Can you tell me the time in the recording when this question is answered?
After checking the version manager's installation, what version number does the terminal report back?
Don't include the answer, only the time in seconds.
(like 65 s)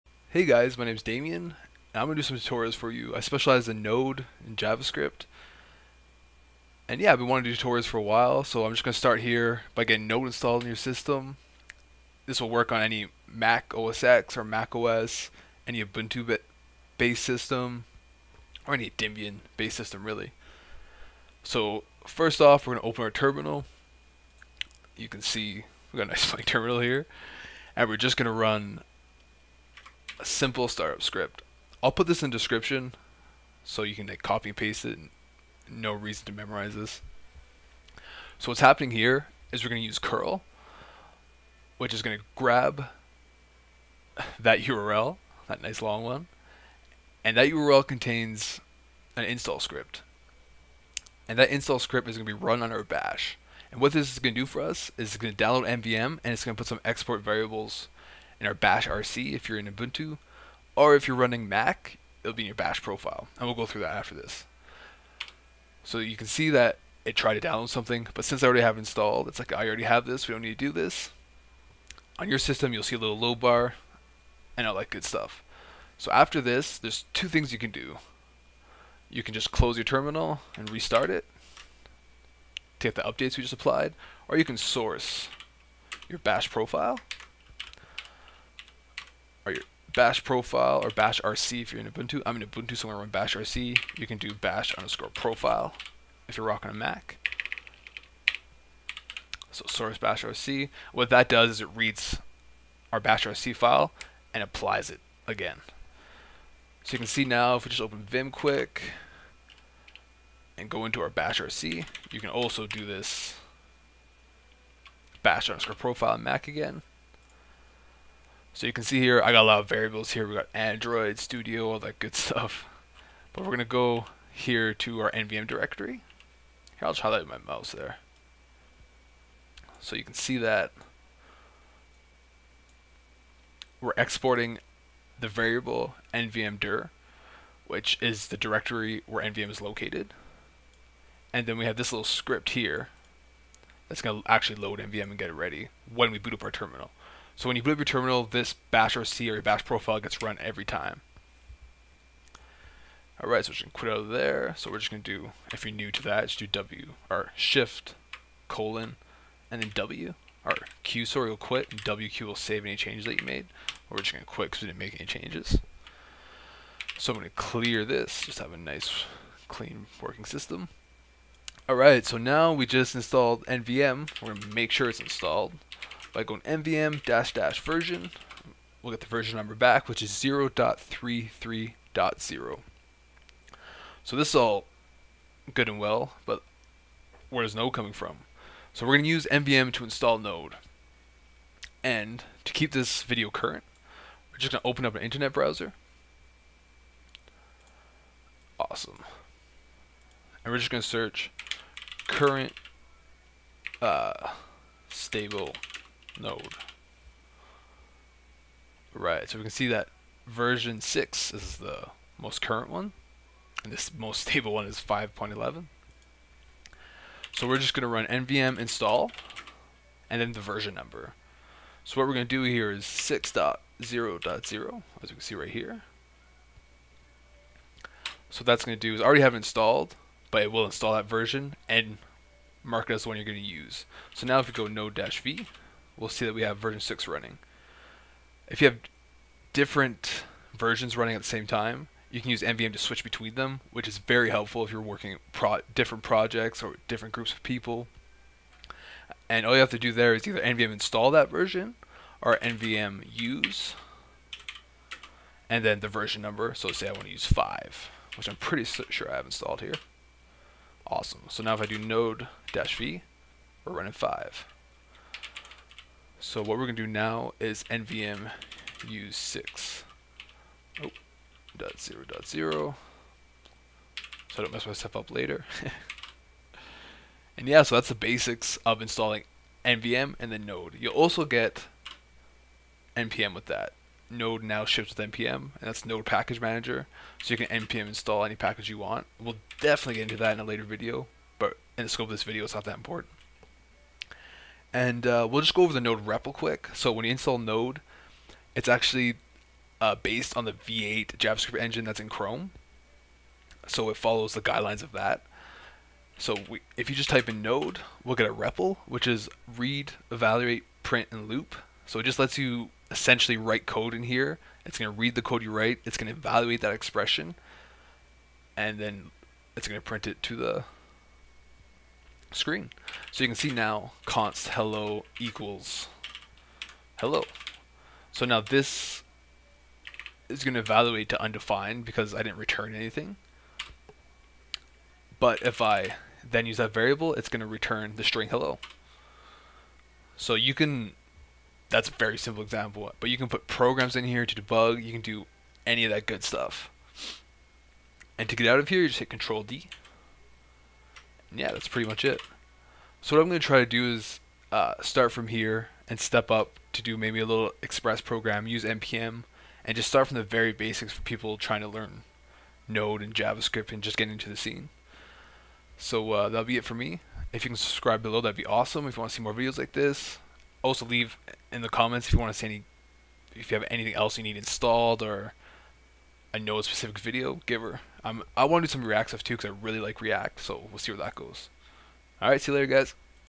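180 s.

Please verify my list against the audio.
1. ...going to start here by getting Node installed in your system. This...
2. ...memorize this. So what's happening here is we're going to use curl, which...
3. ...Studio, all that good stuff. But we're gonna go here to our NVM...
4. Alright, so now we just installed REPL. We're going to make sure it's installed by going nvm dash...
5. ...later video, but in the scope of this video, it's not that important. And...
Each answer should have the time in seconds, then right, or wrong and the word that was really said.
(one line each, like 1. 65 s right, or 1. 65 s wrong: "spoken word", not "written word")
1. 8 s right
2. 36 s right
3. 121 s right
4. 171 s wrong: "NVM", not "REPL"
5. 290 s right.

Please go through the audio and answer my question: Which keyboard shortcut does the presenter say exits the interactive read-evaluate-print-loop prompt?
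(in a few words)
Control D.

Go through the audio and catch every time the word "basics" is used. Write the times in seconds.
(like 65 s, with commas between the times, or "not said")
277 s, 360 s.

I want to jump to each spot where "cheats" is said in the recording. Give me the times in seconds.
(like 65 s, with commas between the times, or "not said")
not said.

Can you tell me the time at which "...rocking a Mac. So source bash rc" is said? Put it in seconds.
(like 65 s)
96 s.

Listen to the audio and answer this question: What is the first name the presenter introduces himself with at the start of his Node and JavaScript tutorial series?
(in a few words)
Damien.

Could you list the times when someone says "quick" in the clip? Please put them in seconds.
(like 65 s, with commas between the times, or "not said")
108 s, 296 s.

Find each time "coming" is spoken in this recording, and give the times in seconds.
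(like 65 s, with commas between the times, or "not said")
187 s.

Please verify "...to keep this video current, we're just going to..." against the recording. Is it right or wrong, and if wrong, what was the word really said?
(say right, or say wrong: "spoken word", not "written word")
right.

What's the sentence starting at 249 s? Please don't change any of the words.
And all you have to do there is either NVM install that version or NVM use and then the version number.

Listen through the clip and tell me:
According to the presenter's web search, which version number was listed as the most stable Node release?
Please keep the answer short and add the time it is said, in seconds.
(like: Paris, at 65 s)
5.11, at 214 s.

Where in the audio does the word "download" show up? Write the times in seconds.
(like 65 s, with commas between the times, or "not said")
55 s, 67 s.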